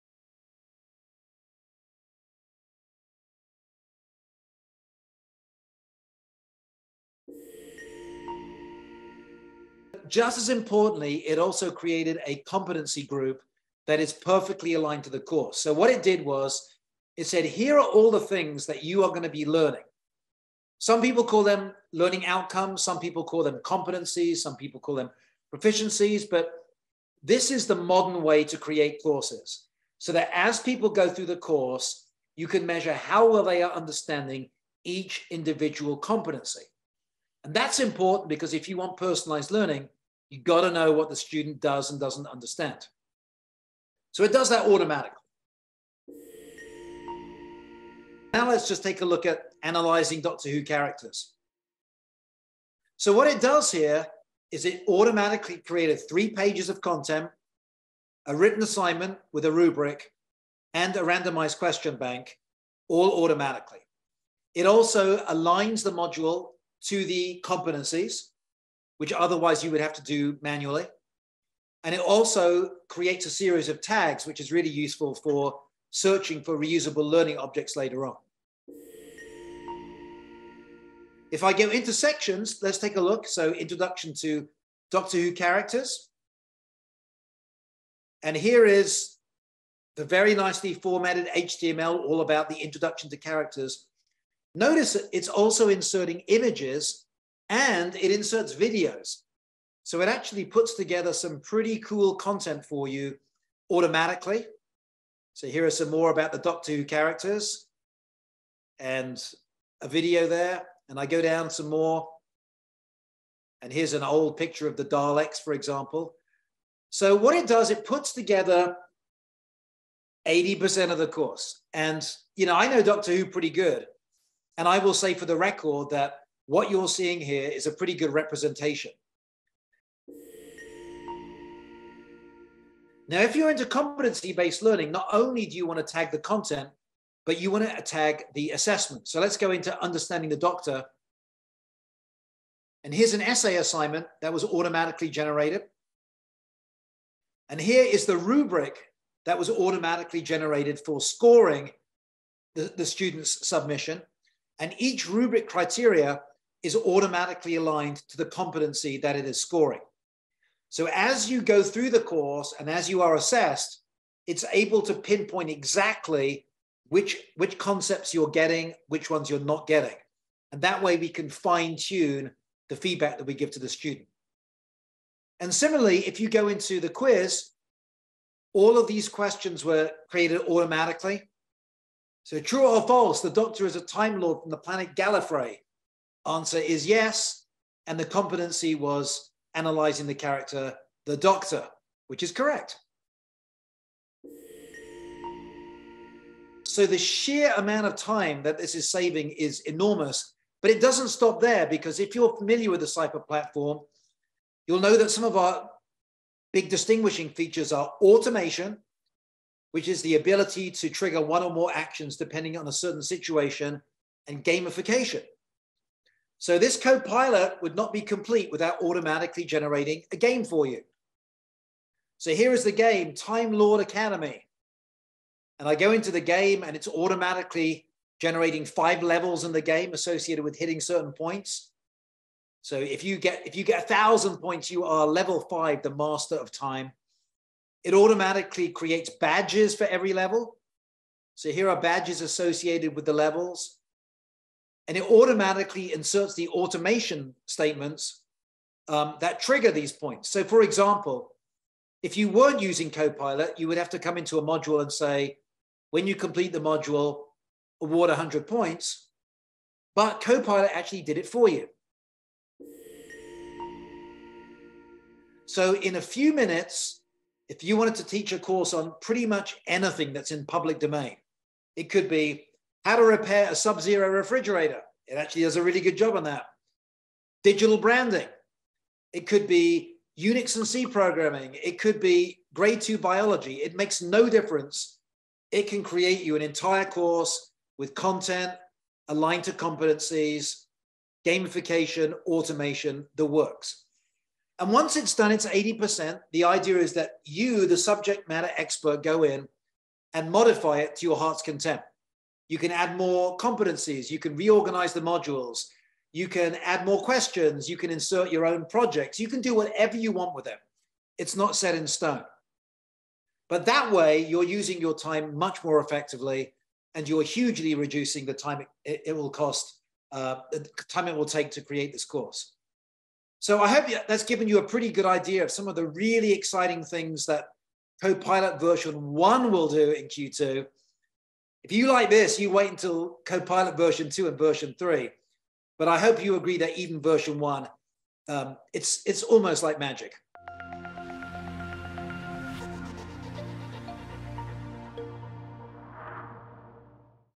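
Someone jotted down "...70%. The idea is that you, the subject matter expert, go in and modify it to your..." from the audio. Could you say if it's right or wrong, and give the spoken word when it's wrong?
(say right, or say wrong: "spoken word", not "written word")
wrong: "80", not "70".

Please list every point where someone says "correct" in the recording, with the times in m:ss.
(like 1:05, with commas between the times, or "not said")
3:12.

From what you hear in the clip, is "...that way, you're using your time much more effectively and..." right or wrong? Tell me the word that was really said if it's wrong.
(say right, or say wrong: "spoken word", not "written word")
right.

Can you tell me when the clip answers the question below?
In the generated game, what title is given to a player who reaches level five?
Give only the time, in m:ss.
3:55.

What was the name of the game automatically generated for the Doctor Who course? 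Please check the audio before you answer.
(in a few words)
Time Lord Academy.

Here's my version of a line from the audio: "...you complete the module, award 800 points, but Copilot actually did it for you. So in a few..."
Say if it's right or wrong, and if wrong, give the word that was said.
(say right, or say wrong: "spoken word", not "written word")
wrong: "100", not "800".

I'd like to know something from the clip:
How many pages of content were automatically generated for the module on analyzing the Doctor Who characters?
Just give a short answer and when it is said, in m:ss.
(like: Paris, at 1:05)
3, at 0:56.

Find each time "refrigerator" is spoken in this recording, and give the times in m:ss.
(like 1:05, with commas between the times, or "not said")
4:34.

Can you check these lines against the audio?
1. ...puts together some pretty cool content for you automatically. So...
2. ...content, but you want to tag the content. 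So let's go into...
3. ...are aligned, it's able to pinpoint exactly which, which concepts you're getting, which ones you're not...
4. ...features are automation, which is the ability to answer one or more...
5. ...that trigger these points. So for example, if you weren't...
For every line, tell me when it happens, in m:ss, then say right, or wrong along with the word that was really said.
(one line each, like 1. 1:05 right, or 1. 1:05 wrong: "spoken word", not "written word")
1. 1:40 right
2. 2:16 wrong: "assessment", not "content"
3. 2:43 wrong: "assessed", not "aligned"
4. 3:27 wrong: "trigger", not "answer"
5. 4:09 right.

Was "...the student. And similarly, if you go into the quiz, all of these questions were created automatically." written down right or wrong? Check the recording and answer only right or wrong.
right.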